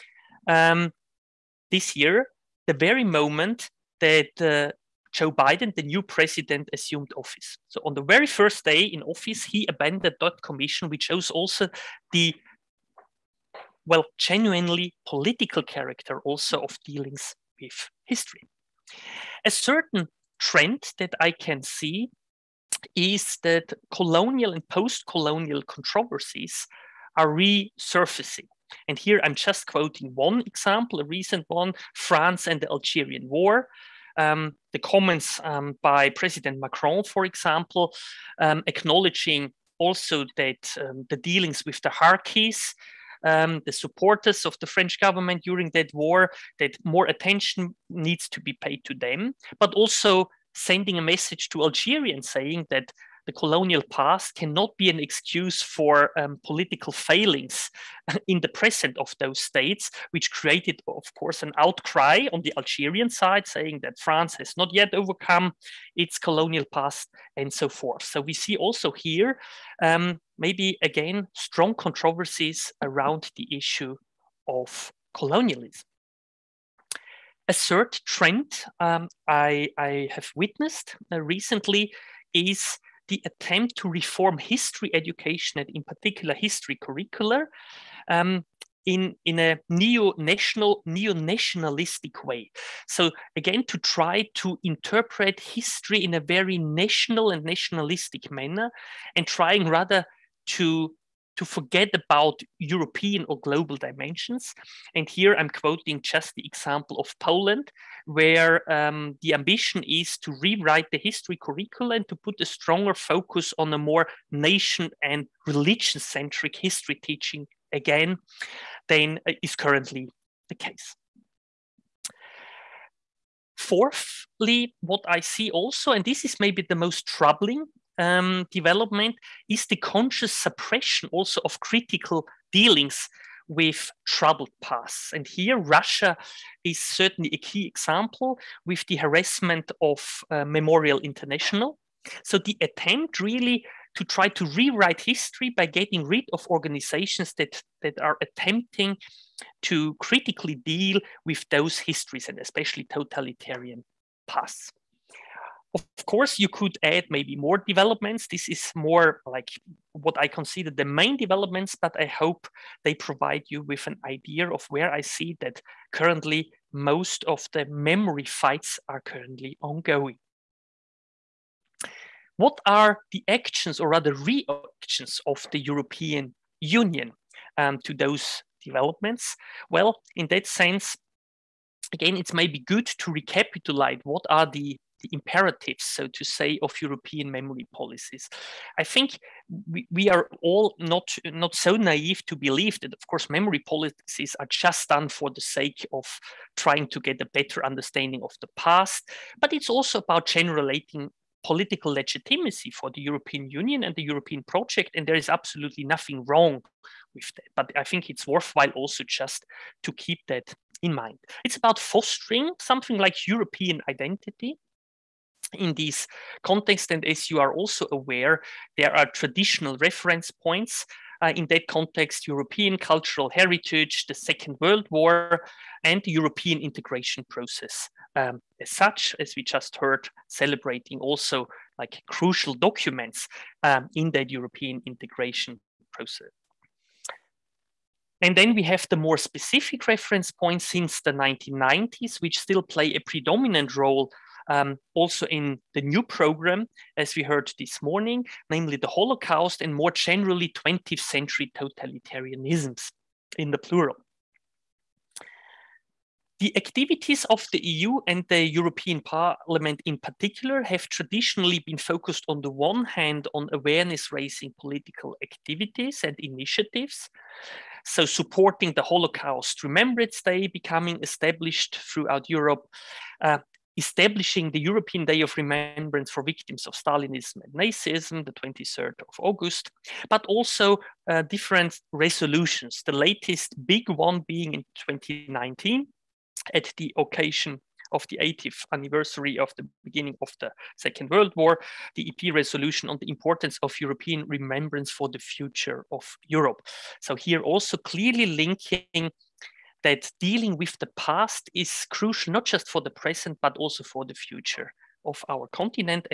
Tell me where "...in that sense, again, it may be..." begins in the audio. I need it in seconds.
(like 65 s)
180 s.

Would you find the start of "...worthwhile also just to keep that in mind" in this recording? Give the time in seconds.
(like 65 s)
208 s.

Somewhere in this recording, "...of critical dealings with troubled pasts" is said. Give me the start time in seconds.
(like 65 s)
131 s.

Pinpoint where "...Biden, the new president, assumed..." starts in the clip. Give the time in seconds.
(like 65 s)
5 s.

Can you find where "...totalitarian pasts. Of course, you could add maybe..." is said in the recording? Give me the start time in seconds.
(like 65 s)
152 s.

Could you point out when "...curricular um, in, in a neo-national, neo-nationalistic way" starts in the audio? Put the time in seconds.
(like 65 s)
86 s.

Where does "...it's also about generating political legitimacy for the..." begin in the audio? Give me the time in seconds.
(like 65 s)
199 s.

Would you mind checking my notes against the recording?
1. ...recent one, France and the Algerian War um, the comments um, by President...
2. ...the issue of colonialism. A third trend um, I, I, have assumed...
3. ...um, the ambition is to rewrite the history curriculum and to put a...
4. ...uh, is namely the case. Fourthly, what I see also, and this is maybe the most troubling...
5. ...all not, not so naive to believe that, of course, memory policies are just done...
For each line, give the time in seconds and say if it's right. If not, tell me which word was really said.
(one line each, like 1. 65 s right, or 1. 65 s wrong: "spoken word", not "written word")
1. 31 s right
2. 73 s wrong: "witnessed", not "assumed"
3. 108 s right
4. 119 s wrong: "currently", not "namely"
5. 190 s right.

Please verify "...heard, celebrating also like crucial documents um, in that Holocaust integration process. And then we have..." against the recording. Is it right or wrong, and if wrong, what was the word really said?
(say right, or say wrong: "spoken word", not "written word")
wrong: "European", not "Holocaust".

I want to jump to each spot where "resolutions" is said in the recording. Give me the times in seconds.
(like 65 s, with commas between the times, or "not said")
281 s, 292 s.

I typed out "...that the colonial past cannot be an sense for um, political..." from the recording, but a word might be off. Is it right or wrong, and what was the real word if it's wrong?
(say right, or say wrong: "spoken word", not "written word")
wrong: "excuse", not "sense".